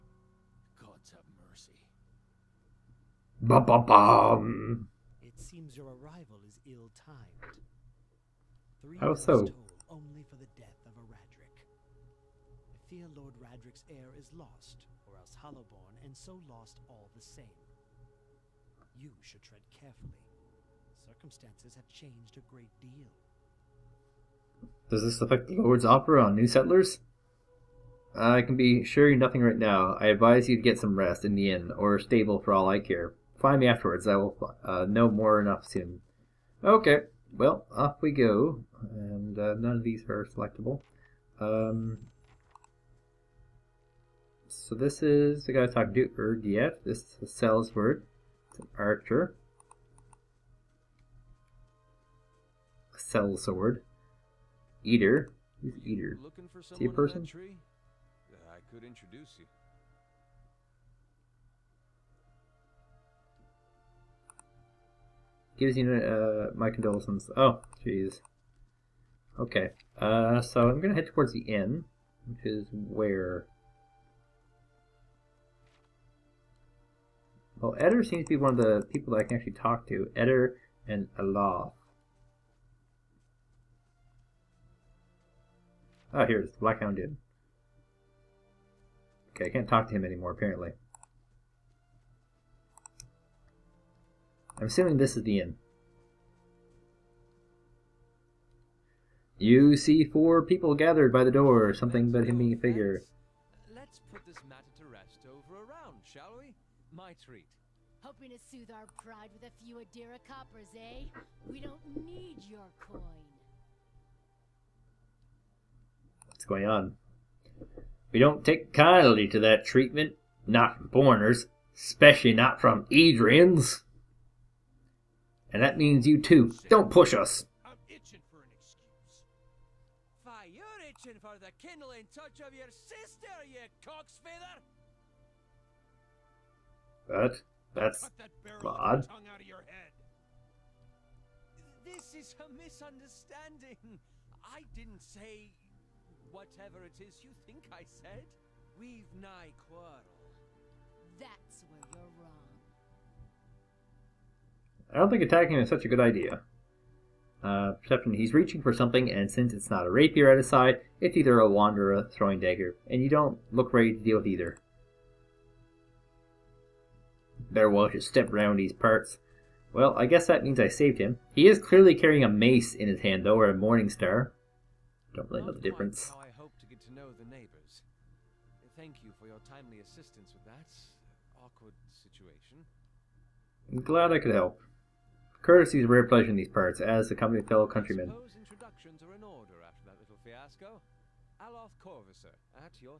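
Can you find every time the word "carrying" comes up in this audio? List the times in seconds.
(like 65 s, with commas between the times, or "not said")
171 s.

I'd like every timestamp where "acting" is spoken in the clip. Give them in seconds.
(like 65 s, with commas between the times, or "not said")
not said.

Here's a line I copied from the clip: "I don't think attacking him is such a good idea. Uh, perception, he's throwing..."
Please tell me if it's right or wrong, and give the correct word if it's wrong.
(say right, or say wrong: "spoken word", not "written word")
wrong: "reaching", not "throwing".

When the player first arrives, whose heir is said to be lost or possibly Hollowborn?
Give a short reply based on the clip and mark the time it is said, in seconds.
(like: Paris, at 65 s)
Lord Raedric, at 13 s.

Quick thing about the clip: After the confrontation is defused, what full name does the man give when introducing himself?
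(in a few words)
Aloth Corfiser.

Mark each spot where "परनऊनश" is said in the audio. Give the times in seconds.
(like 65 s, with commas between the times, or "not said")
not said.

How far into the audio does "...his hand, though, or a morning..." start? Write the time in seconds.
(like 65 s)
172 s.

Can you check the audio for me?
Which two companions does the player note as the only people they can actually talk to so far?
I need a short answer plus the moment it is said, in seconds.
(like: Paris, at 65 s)
Eder and Aloth, at 80 s.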